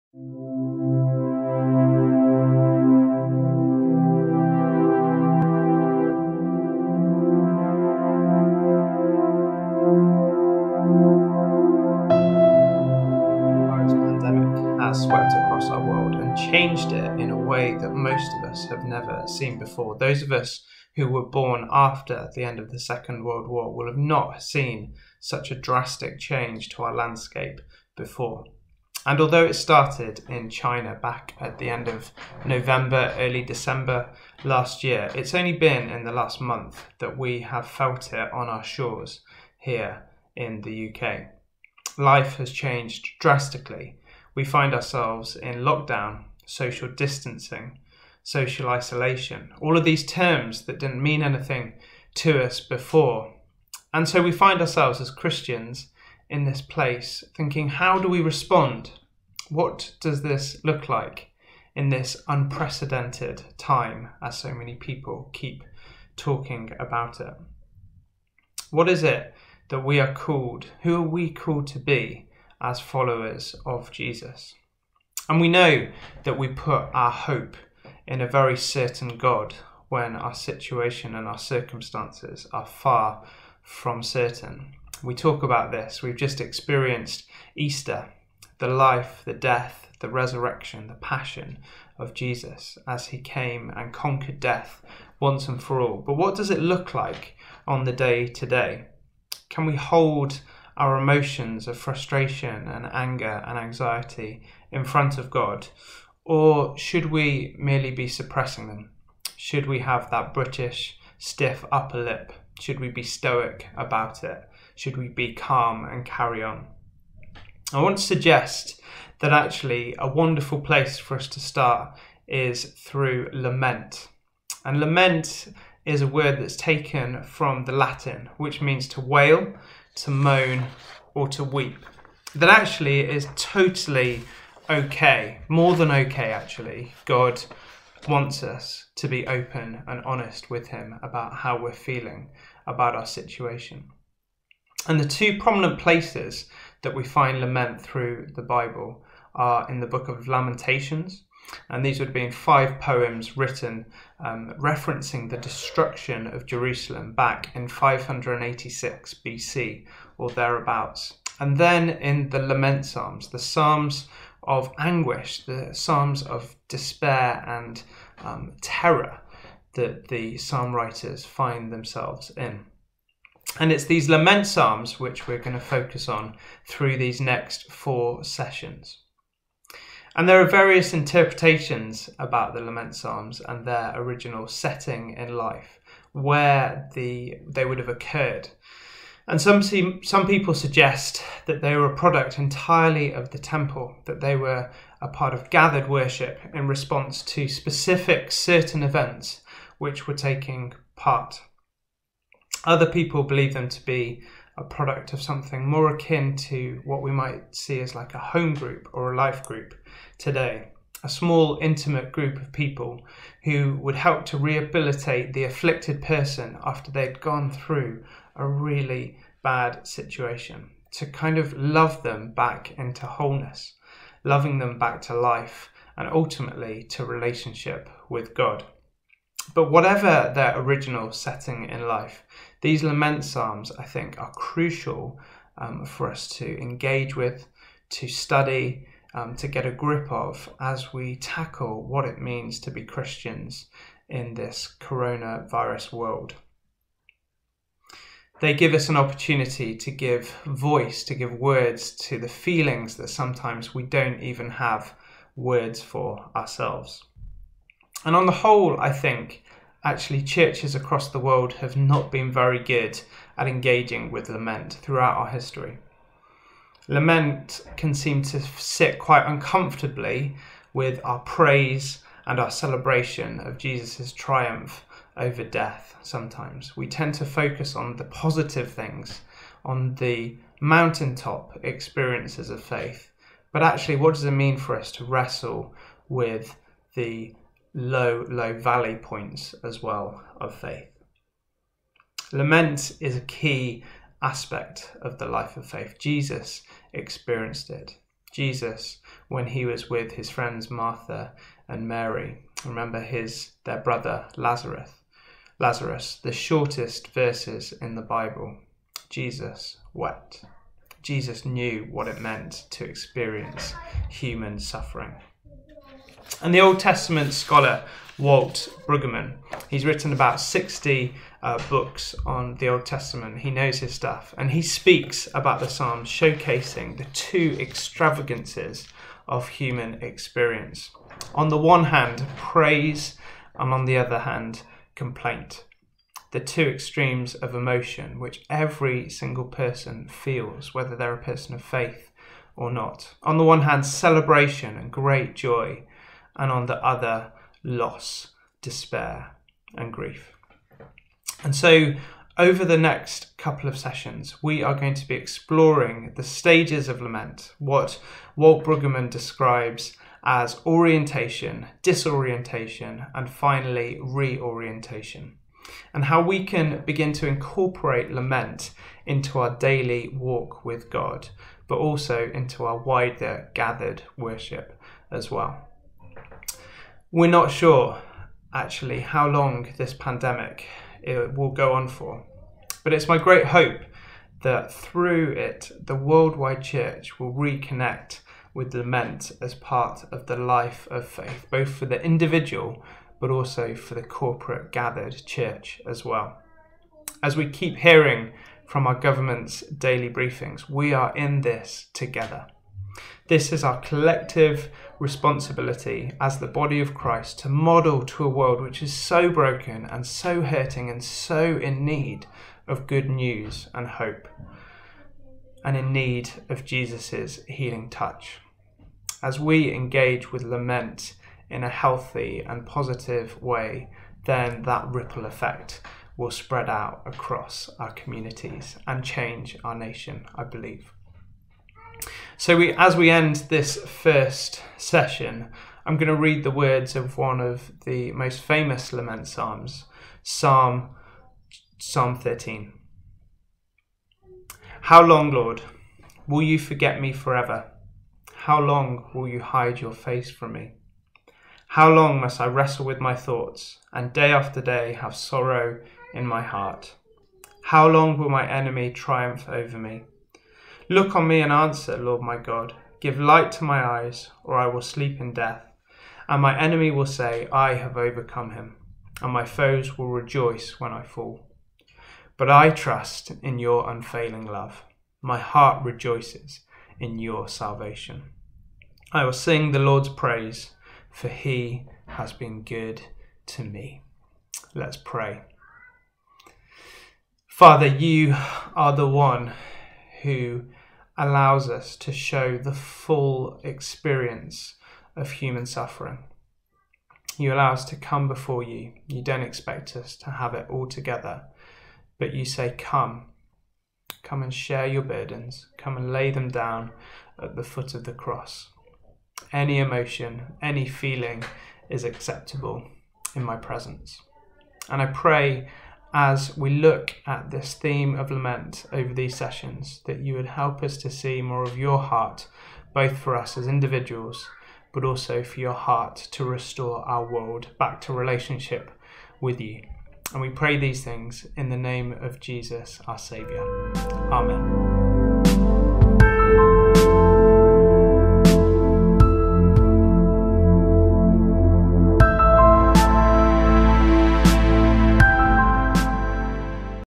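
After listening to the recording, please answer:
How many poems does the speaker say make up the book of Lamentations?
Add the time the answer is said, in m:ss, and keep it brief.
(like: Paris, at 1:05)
5, at 2:32.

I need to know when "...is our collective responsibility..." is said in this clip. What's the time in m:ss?
6:43.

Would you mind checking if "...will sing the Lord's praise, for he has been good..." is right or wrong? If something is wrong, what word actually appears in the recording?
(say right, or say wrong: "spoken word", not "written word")
right.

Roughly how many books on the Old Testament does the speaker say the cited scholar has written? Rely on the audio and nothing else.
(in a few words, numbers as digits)
60.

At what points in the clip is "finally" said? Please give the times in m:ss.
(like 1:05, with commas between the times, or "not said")
6:03.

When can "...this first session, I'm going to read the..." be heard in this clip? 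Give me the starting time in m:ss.
7:13.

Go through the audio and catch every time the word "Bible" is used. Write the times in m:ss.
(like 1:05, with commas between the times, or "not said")
2:28, 5:08.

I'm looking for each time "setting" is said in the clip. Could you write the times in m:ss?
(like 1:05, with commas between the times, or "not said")
3:04, 3:51.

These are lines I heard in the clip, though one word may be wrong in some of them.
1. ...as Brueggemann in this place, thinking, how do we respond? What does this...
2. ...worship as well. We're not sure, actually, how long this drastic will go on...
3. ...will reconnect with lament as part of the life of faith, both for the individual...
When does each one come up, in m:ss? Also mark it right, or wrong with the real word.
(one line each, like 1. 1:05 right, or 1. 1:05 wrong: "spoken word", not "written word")
1. 0:55 wrong: "Christians", not "Brueggemann"
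2. 6:14 wrong: "pandemic", not "drastic"
3. 6:27 right.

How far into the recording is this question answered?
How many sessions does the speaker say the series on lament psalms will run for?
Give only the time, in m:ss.
2:57.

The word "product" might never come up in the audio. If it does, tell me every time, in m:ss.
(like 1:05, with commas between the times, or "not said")
3:11, 3:24.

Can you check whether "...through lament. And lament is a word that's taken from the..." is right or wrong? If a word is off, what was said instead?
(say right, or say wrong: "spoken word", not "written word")
right.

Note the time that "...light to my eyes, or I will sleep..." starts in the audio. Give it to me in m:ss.
7:43.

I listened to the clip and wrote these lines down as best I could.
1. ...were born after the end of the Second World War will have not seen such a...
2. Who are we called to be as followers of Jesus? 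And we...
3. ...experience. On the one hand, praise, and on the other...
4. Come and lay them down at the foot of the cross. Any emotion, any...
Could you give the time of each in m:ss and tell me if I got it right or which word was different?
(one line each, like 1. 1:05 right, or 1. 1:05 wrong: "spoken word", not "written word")
1. 0:21 right
2. 1:10 right
3. 5:30 right
4. 8:25 right.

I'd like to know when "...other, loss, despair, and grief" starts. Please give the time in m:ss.
5:46.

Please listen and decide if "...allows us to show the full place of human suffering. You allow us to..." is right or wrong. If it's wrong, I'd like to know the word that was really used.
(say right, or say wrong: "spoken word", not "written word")
wrong: "experience", not "place".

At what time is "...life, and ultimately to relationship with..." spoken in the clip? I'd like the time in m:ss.
3:45.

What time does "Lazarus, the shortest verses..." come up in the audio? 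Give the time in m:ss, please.
5:05.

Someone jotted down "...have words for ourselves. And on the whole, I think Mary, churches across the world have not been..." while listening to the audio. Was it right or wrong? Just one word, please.
wrong.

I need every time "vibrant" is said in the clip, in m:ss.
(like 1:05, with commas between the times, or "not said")
not said.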